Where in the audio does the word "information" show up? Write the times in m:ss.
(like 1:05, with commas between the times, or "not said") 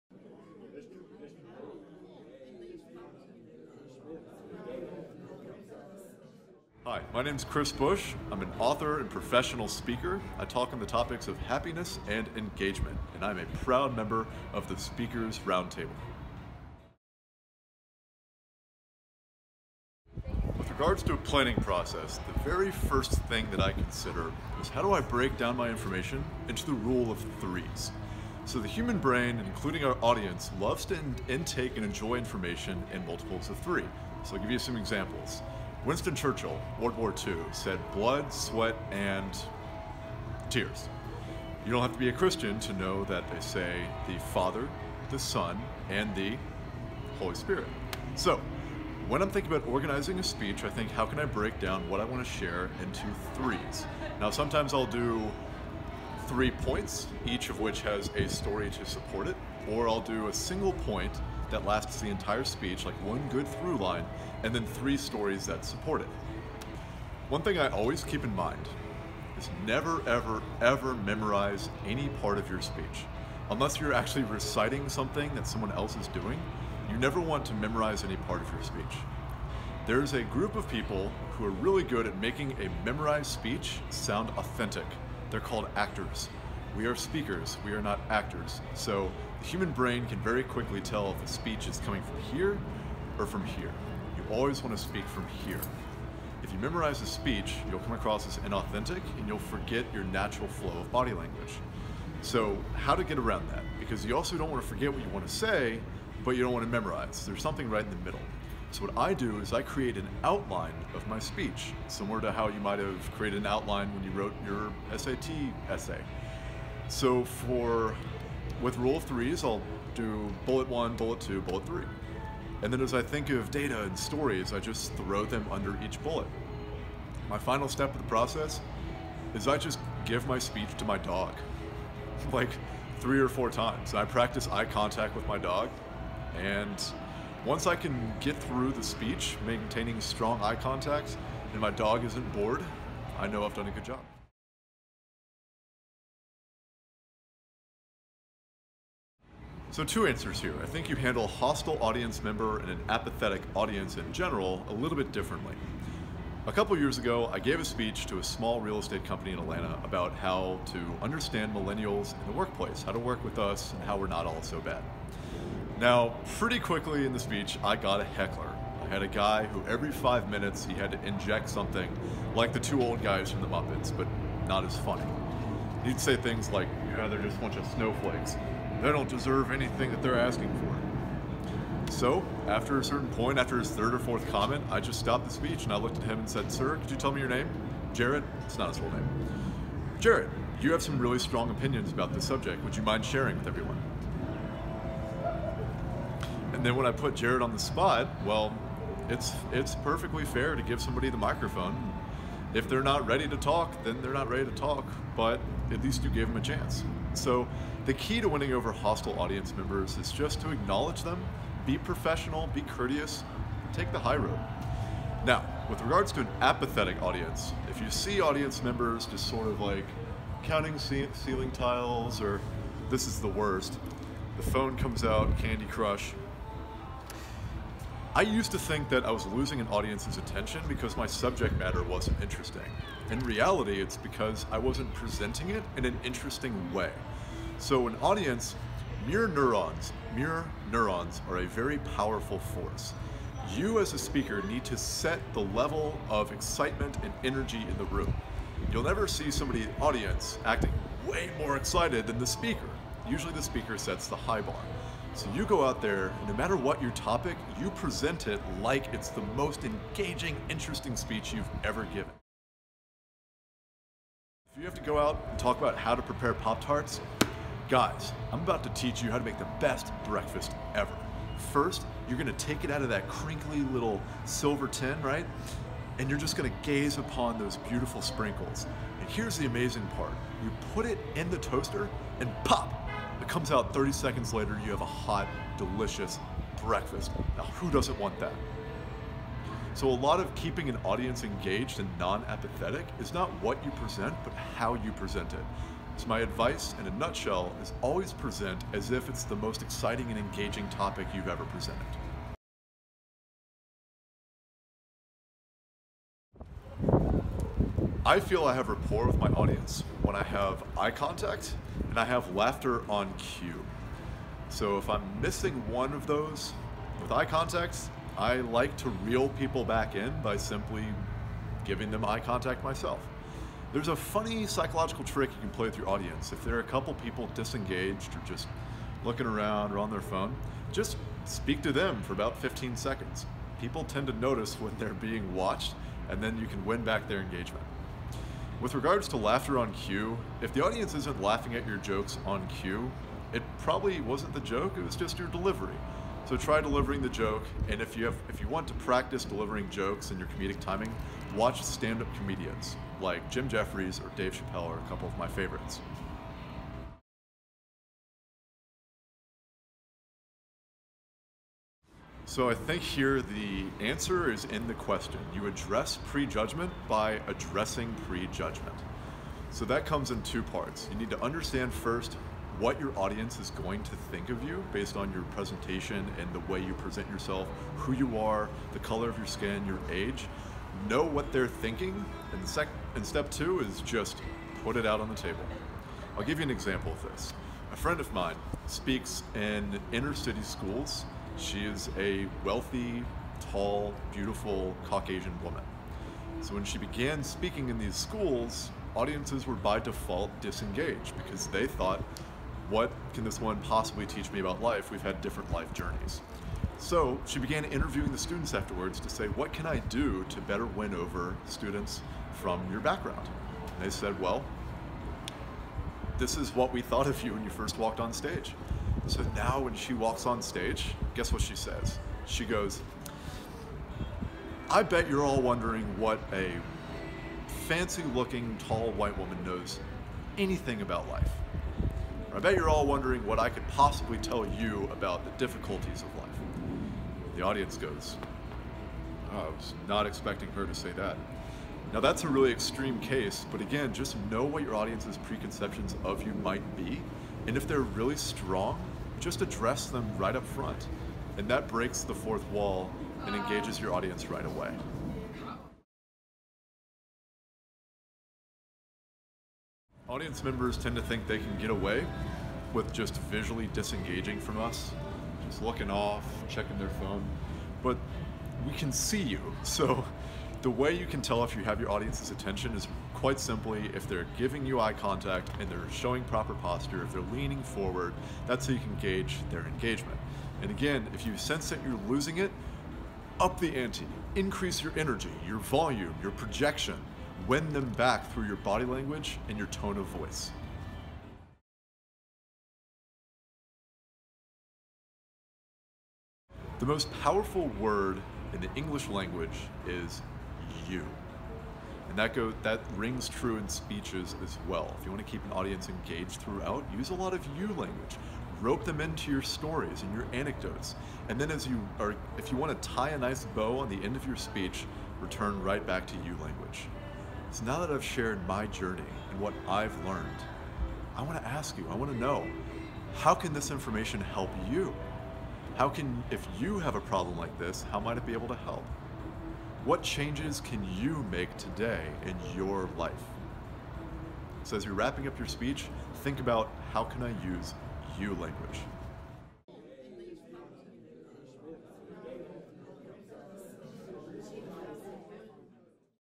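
0:25, 0:32, 8:43.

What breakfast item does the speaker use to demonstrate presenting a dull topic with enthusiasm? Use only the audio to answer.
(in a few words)
Pop-Tarts.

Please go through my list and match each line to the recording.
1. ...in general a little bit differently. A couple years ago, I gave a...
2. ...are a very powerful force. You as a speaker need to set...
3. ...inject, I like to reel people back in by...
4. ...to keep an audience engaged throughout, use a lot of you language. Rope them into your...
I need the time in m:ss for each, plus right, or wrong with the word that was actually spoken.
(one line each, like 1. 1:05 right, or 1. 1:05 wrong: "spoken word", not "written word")
1. 2:33 right
2. 4:01 right
3. 5:17 wrong: "contact", not "inject"
4. 8:25 right.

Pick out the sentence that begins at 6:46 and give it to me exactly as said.
So she began interviewing the students afterwards to say, what can I do to better win over students from your background?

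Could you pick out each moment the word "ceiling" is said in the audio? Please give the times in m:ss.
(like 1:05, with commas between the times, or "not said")
3:40.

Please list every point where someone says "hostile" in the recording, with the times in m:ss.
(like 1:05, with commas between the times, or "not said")
2:31, 3:28.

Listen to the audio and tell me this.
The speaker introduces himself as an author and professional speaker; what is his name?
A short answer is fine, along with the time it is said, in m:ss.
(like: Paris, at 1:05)
Chris Bush, at 0:07.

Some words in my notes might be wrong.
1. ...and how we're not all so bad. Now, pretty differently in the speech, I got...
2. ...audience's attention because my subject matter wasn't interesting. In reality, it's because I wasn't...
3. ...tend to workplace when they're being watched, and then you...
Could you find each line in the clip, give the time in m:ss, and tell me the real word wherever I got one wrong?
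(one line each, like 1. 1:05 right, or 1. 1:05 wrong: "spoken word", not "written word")
1. 2:43 wrong: "quickly", not "differently"
2. 3:49 right
3. 5:33 wrong: "notice", not "workplace".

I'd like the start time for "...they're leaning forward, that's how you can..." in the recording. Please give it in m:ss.
7:57.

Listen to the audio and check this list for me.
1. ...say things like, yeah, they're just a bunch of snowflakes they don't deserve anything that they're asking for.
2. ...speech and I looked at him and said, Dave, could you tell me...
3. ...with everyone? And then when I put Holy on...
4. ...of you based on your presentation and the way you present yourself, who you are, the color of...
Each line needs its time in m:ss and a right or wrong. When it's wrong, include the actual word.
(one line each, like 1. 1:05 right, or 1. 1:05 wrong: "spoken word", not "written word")
1. 2:55 right
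2. 3:05 wrong: "Sir", not "Dave"
3. 3:13 wrong: "Jared", not "Holy"
4. 6:14 right.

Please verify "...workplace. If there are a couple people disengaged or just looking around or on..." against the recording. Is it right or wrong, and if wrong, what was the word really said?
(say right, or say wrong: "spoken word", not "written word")
wrong: "audience", not "workplace".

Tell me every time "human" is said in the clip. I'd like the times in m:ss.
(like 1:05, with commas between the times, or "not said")
0:28, 1:29.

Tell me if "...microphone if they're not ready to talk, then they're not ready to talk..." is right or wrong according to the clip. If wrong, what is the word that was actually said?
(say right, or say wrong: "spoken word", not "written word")
right.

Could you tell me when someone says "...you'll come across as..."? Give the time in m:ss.
1:37.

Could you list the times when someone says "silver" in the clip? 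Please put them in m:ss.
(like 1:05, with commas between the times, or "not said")
4:34.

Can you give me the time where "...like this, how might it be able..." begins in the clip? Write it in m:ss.
8:47.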